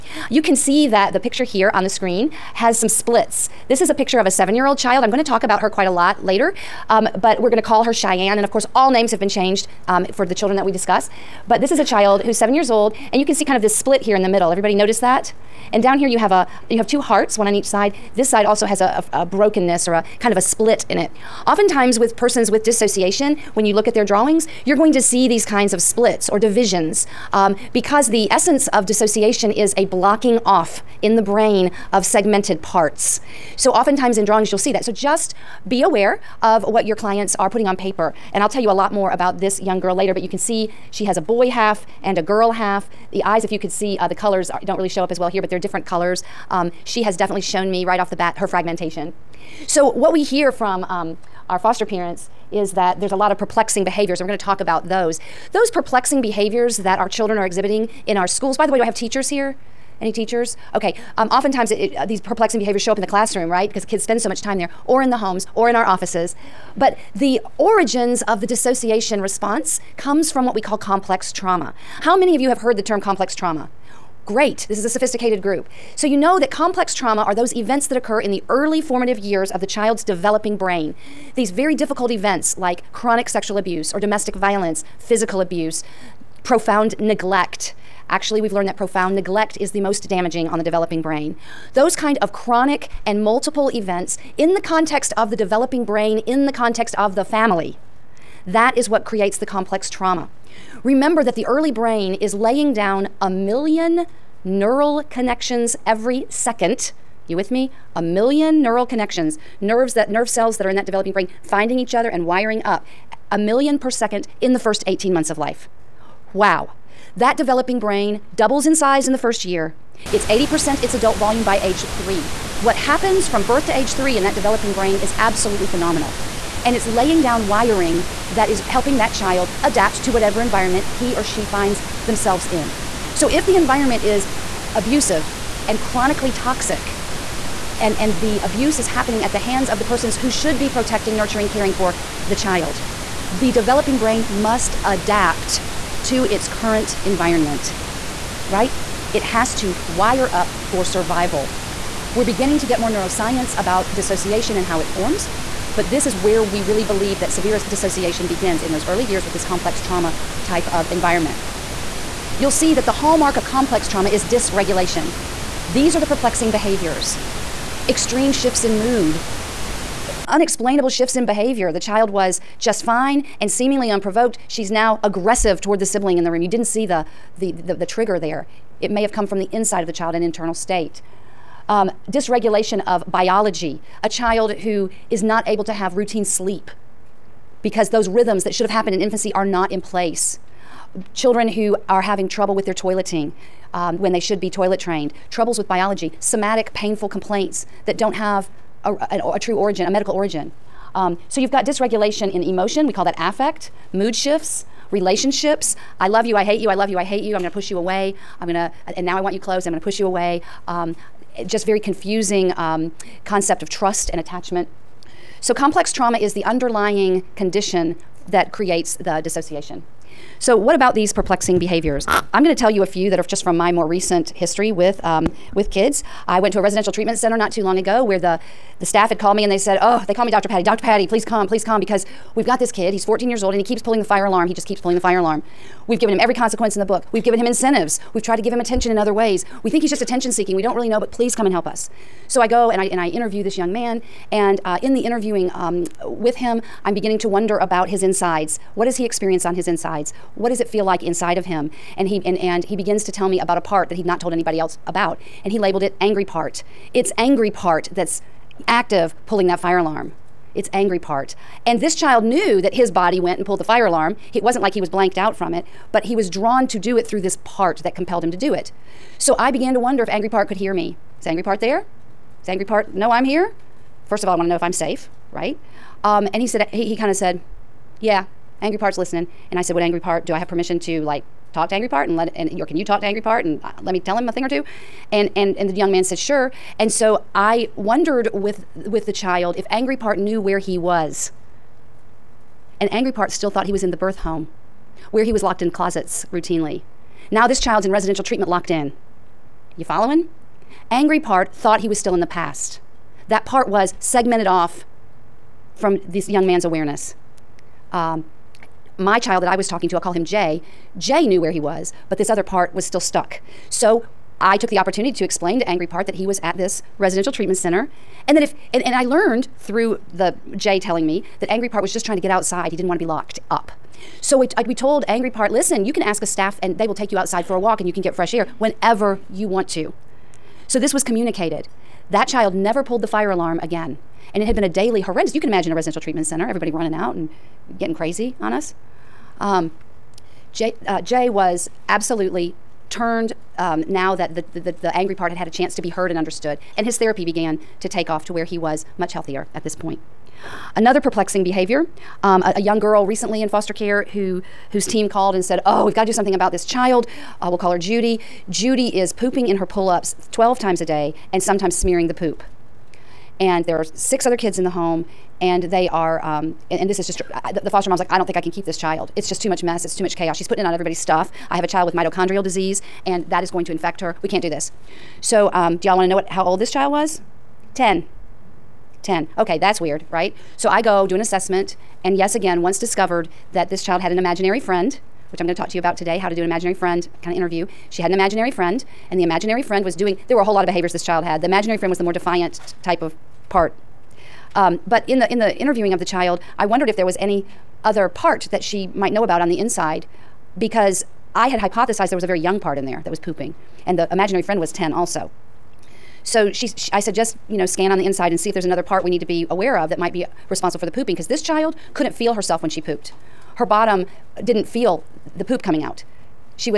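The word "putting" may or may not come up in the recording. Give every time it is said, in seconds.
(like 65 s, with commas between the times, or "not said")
37 s, 370 s.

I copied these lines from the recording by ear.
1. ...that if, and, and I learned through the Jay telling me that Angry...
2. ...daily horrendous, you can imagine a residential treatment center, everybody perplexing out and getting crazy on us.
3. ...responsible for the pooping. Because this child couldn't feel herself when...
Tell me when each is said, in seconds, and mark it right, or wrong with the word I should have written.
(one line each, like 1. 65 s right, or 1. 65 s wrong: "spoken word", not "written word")
1. 318 s right
2. 334 s wrong: "running", not "perplexing"
3. 410 s right.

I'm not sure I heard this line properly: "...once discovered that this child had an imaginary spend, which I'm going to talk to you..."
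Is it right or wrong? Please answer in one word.
wrong.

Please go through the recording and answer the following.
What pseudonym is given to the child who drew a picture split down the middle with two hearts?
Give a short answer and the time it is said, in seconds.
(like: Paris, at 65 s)
Cheyenne, at 7 s.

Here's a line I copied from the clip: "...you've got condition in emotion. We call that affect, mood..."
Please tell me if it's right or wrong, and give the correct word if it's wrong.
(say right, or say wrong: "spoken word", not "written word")
wrong: "dysregulation", not "condition".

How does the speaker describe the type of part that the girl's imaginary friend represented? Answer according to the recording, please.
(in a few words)
Defiant.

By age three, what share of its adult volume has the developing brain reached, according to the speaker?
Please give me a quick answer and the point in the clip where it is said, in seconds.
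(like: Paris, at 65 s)
80%, at 120 s.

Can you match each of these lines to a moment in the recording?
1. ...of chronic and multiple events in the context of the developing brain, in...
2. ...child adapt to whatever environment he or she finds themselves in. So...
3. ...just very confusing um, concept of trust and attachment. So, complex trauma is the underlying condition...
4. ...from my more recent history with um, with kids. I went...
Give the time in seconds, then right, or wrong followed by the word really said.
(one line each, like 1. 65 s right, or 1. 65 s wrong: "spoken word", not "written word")
1. 92 s right
2. 129 s right
3. 211 s right
4. 223 s right.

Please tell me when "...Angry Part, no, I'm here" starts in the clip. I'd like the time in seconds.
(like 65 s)
272 s.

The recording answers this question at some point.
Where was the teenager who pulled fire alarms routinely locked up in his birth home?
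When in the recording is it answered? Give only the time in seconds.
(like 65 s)
295 s.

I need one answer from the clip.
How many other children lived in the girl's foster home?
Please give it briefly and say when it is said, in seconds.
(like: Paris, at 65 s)
6, at 363 s.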